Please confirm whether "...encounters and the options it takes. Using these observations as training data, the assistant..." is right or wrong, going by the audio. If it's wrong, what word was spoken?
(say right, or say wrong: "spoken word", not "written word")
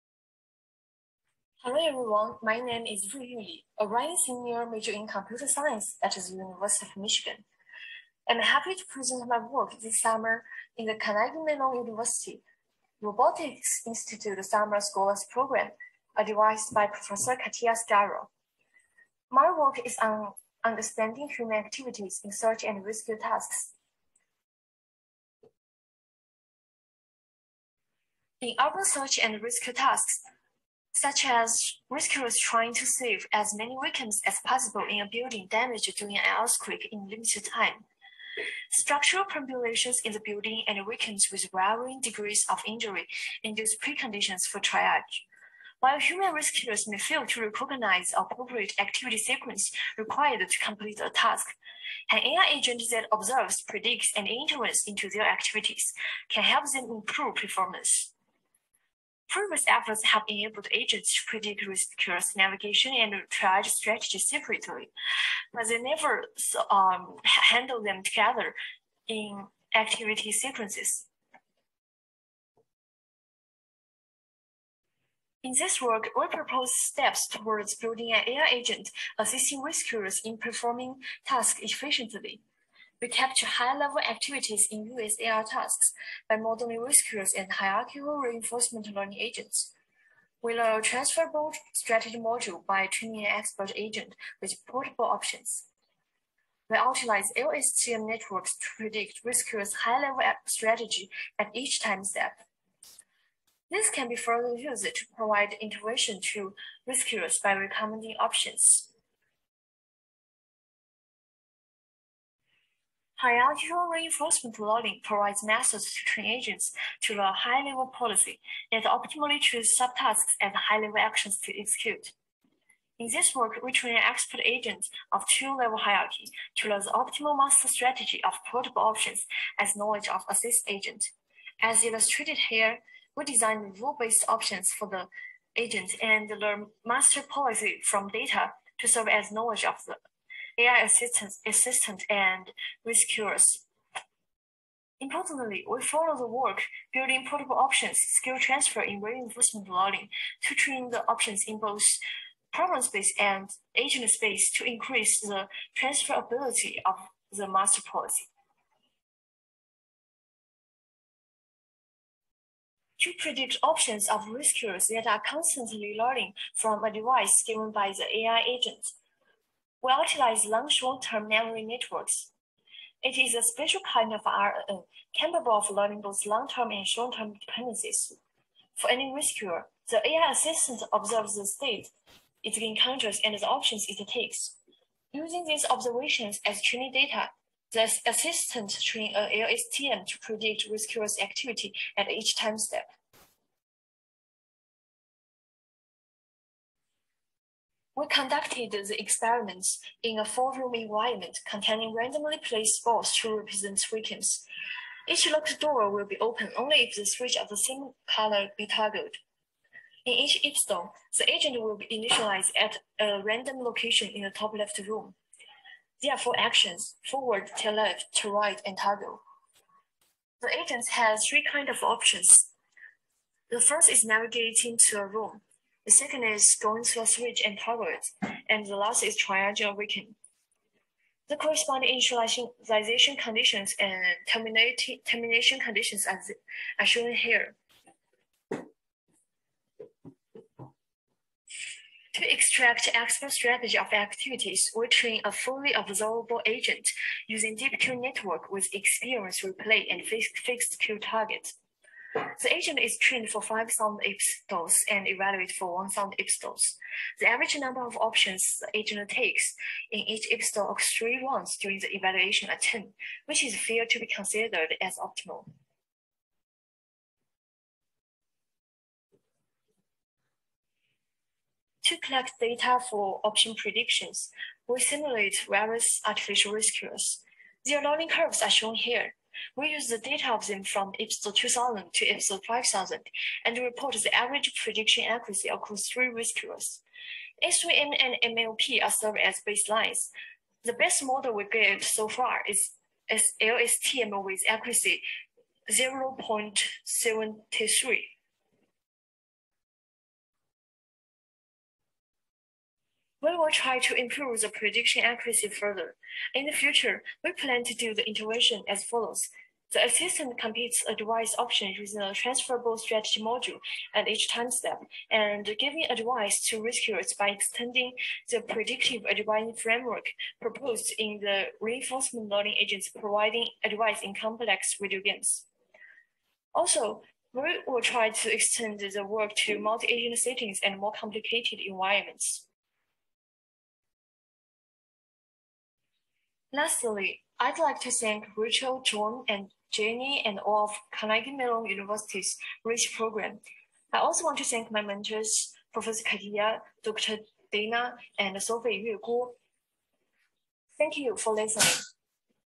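right.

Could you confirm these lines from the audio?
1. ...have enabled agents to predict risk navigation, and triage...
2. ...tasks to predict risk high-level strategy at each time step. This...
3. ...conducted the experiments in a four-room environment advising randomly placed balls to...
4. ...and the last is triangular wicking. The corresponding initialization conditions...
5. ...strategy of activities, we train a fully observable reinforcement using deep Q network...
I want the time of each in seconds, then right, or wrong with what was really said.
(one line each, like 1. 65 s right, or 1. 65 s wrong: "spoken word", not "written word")
1. 60 s right
2. 98 s wrong: "networks", not "tasks"
3. 198 s wrong: "containing", not "advising"
4. 228 s right
5. 243 s wrong: "agent", not "reinforcement".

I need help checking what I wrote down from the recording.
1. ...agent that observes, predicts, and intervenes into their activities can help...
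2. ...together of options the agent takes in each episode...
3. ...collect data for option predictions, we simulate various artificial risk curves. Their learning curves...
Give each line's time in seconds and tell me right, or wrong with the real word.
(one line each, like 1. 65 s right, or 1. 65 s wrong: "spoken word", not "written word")
1. 52 s right
2. 257 s wrong: "number", not "together"
3. 271 s right.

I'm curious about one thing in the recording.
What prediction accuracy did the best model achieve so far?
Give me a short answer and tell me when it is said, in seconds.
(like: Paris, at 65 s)
0.73, at 295 s.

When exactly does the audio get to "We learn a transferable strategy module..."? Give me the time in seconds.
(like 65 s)
90 s.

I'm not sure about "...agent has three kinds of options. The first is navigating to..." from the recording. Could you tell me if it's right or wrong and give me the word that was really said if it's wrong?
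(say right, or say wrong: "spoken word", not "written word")
right.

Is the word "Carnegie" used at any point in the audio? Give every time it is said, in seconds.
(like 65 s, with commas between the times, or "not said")
10 s, 340 s.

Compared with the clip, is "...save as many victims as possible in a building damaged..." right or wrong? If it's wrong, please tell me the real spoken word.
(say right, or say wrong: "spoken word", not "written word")
right.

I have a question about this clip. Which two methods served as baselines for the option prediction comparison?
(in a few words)
SVM and MLP.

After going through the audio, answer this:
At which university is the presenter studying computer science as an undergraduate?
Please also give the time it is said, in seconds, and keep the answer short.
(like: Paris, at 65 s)
University of Michigan, at 6 s.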